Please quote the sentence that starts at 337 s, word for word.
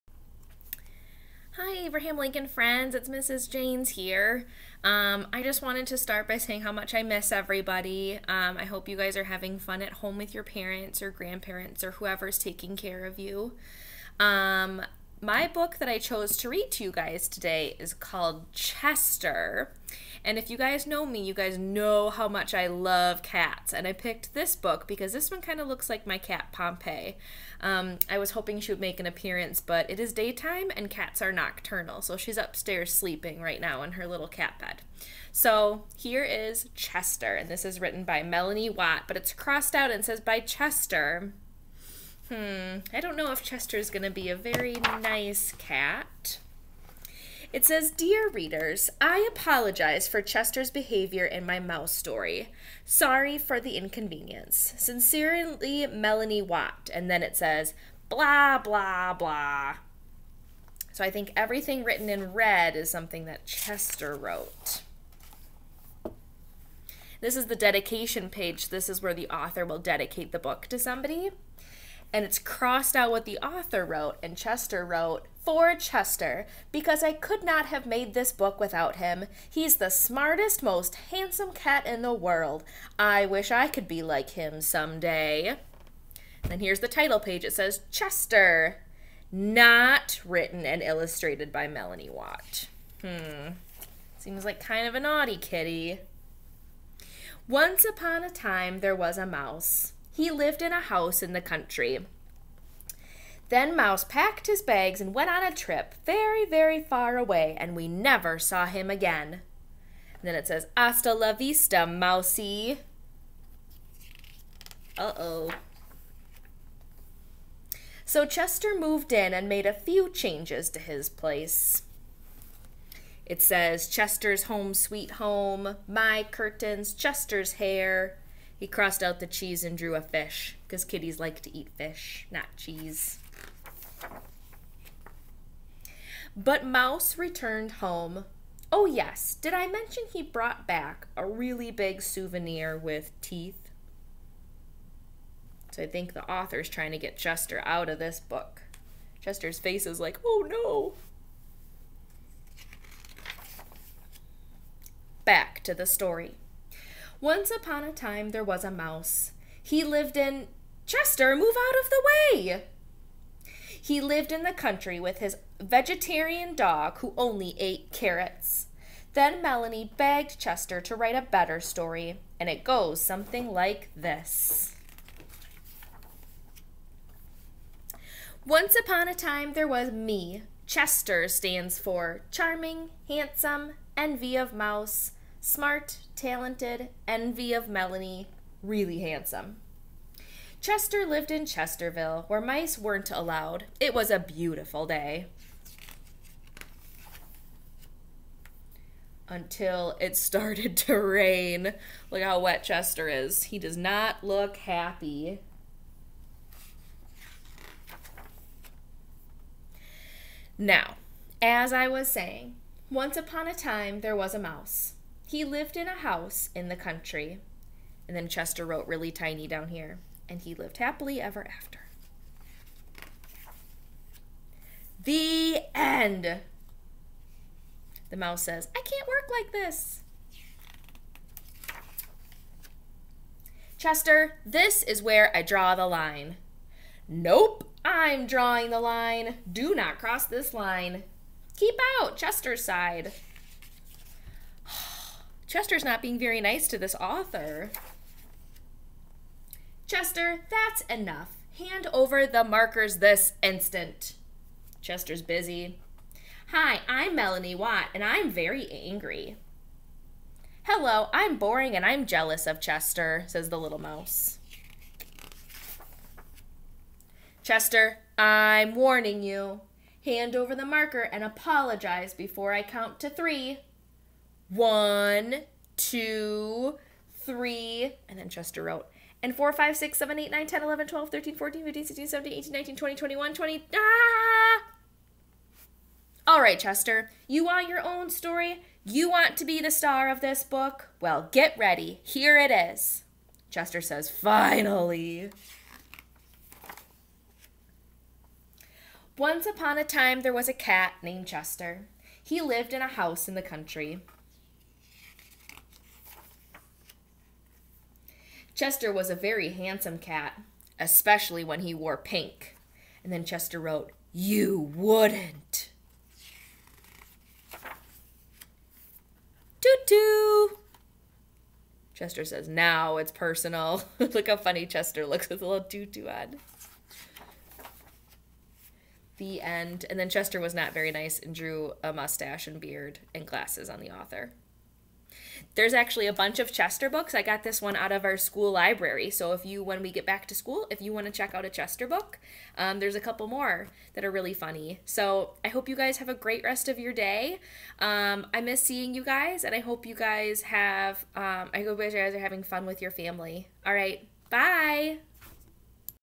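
I got this one out of our school library.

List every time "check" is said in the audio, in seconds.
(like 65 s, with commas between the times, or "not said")
341 s.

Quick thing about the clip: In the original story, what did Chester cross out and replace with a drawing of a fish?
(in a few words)
The cheese.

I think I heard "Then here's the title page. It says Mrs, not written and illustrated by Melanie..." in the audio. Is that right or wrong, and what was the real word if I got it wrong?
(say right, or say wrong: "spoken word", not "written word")
wrong: "Chester", not "Mrs".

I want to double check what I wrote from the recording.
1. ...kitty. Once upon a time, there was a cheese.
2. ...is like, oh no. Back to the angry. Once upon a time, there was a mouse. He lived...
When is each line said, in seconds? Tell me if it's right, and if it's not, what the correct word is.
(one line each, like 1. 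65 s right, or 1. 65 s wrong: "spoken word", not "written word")
1. 95 s wrong: "mouse", not "cheese"
2. 149 s wrong: "story", not "angry".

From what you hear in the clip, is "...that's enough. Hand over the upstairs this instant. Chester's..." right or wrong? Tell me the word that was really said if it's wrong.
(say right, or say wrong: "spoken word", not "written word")
wrong: "markers", not "upstairs".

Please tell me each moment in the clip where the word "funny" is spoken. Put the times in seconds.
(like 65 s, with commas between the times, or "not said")
324 s, 344 s.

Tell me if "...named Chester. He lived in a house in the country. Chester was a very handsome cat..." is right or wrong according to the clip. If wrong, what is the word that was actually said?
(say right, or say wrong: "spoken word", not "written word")
right.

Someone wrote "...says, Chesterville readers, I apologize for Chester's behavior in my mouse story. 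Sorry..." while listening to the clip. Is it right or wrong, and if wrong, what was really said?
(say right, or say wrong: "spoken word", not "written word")
wrong: "Dear", not "Chesterville".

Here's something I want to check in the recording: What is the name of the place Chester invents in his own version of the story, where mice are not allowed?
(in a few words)
Chesterville.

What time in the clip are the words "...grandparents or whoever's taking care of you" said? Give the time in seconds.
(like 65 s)
11 s.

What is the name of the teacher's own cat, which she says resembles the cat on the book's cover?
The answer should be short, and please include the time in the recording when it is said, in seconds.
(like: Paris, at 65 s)
Pompey, at 26 s.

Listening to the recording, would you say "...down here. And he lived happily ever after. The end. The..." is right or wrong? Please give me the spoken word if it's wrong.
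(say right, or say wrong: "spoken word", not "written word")
right.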